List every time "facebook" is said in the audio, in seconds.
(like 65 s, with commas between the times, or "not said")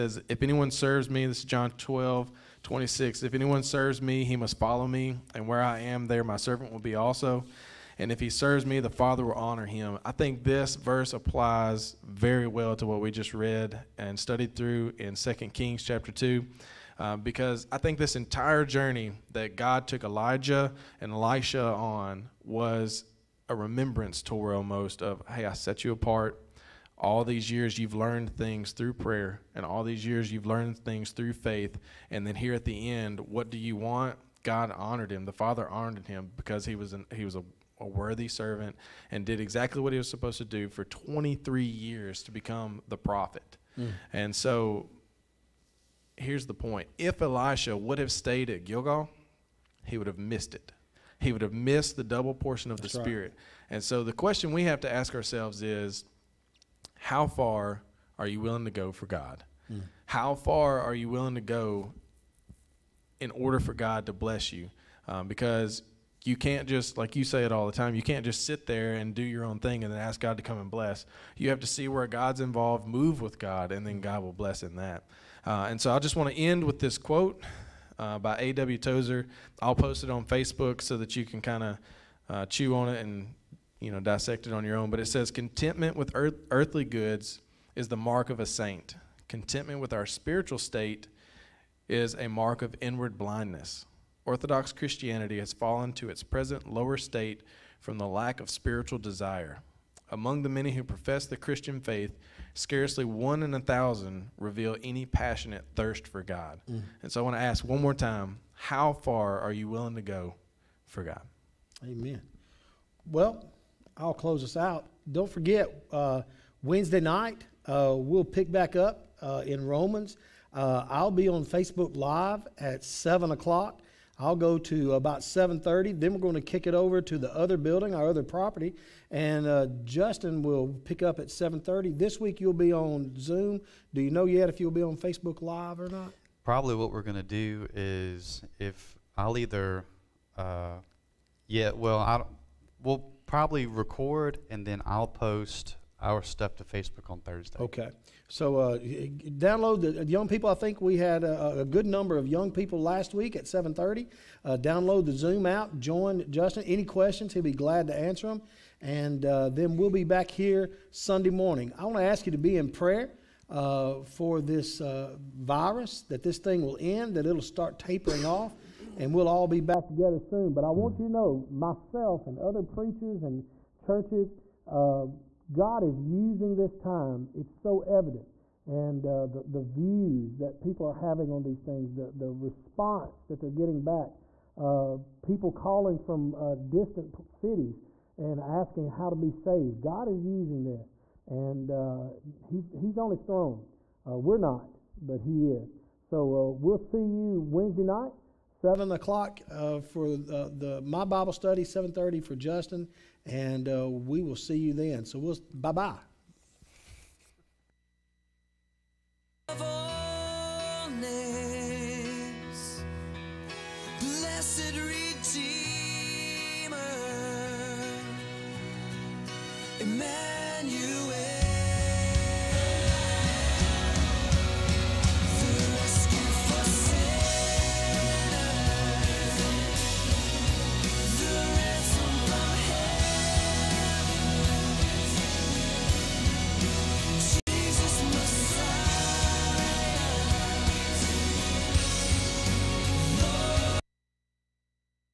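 80 s, 121 s, 134 s, 146 s.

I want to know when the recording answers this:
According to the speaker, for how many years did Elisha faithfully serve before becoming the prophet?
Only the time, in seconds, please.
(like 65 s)
40 s.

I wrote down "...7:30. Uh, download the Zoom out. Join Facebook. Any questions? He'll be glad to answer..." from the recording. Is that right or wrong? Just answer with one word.
wrong.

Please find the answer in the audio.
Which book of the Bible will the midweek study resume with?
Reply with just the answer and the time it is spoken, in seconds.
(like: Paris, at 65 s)
Romans, at 119 s.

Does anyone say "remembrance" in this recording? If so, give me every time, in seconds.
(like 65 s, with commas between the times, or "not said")
23 s.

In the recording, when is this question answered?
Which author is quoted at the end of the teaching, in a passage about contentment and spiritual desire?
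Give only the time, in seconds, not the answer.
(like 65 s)
78 s.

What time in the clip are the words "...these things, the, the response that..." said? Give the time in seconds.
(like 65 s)
181 s.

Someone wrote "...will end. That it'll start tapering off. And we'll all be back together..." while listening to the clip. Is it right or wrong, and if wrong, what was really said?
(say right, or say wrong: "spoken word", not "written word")
right.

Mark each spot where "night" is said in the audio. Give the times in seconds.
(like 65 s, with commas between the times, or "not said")
116 s, 197 s.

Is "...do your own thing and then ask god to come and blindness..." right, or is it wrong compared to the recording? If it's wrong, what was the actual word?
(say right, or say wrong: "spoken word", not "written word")
wrong: "bless", not "blindness".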